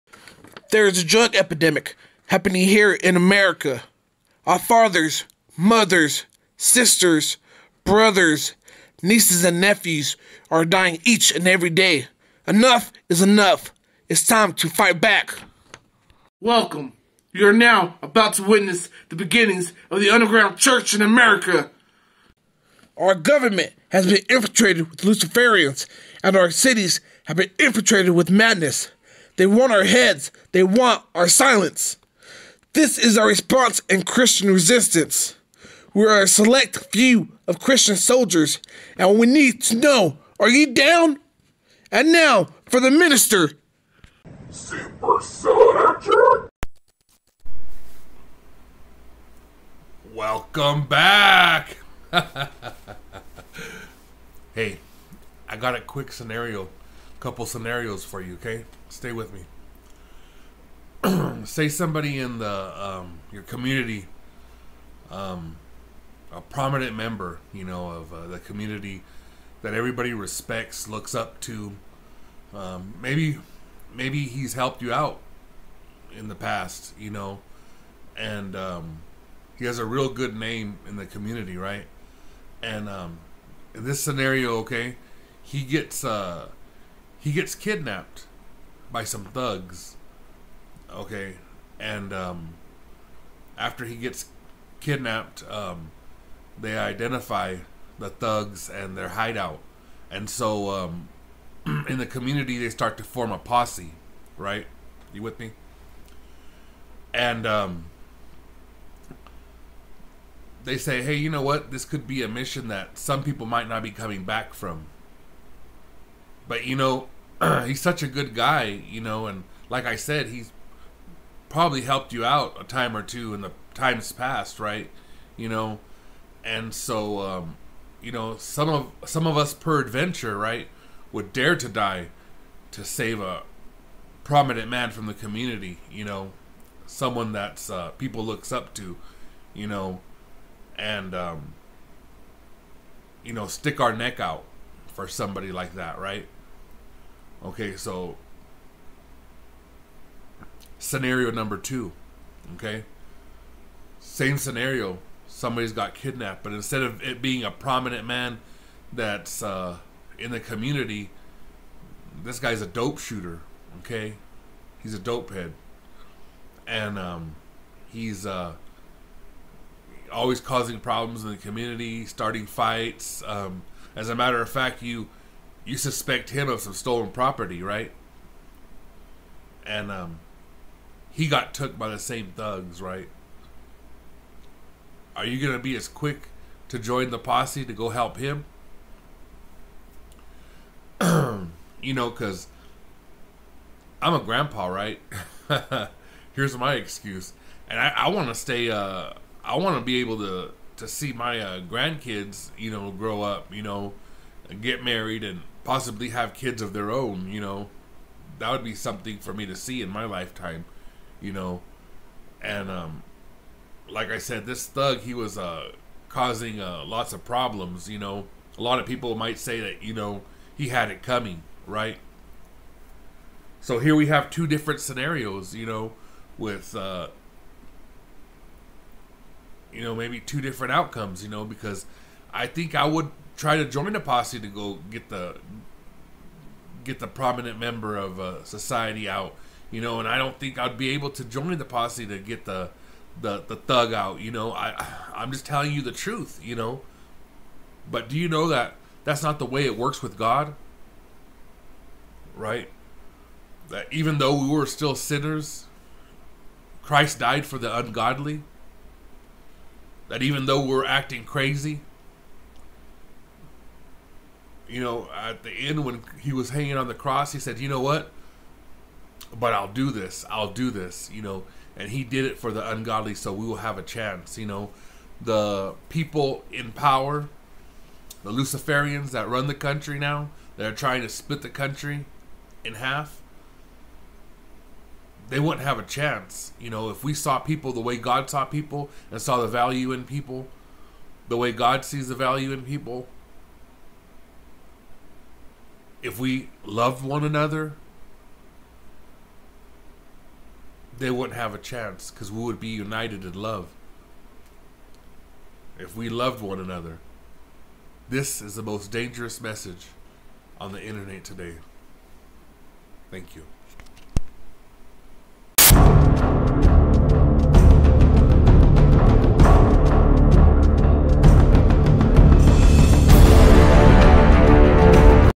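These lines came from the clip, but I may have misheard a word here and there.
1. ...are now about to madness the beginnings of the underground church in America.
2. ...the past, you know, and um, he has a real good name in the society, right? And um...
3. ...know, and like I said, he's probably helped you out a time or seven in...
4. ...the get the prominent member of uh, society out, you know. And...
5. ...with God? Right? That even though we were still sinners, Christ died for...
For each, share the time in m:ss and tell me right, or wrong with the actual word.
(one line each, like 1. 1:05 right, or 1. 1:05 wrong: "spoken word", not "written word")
1. 0:17 wrong: "witness", not "madness"
2. 1:16 wrong: "community", not "society"
3. 1:58 wrong: "two", not "seven"
4. 3:55 right
5. 4:10 right.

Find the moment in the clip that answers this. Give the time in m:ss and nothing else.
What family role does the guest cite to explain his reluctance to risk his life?
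3:14.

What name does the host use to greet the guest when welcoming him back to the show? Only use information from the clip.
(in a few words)
Super Soldier.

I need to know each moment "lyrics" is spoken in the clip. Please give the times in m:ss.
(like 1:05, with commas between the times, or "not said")
not said.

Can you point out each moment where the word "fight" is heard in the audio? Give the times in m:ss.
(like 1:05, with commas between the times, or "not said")
0:14, 2:52.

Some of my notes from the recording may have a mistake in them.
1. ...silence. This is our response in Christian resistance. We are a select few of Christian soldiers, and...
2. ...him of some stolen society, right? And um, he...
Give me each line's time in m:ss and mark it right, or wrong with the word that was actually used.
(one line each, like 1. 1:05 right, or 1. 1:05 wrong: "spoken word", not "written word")
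1. 0:31 right
2. 2:56 wrong: "property", not "society".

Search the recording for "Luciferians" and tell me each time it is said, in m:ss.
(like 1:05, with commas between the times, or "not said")
0:25, 4:38.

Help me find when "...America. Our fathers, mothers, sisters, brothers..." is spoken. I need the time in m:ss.
0:03.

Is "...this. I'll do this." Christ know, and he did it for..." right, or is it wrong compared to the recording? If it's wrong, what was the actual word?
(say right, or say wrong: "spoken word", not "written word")
wrong: "You", not "Christ".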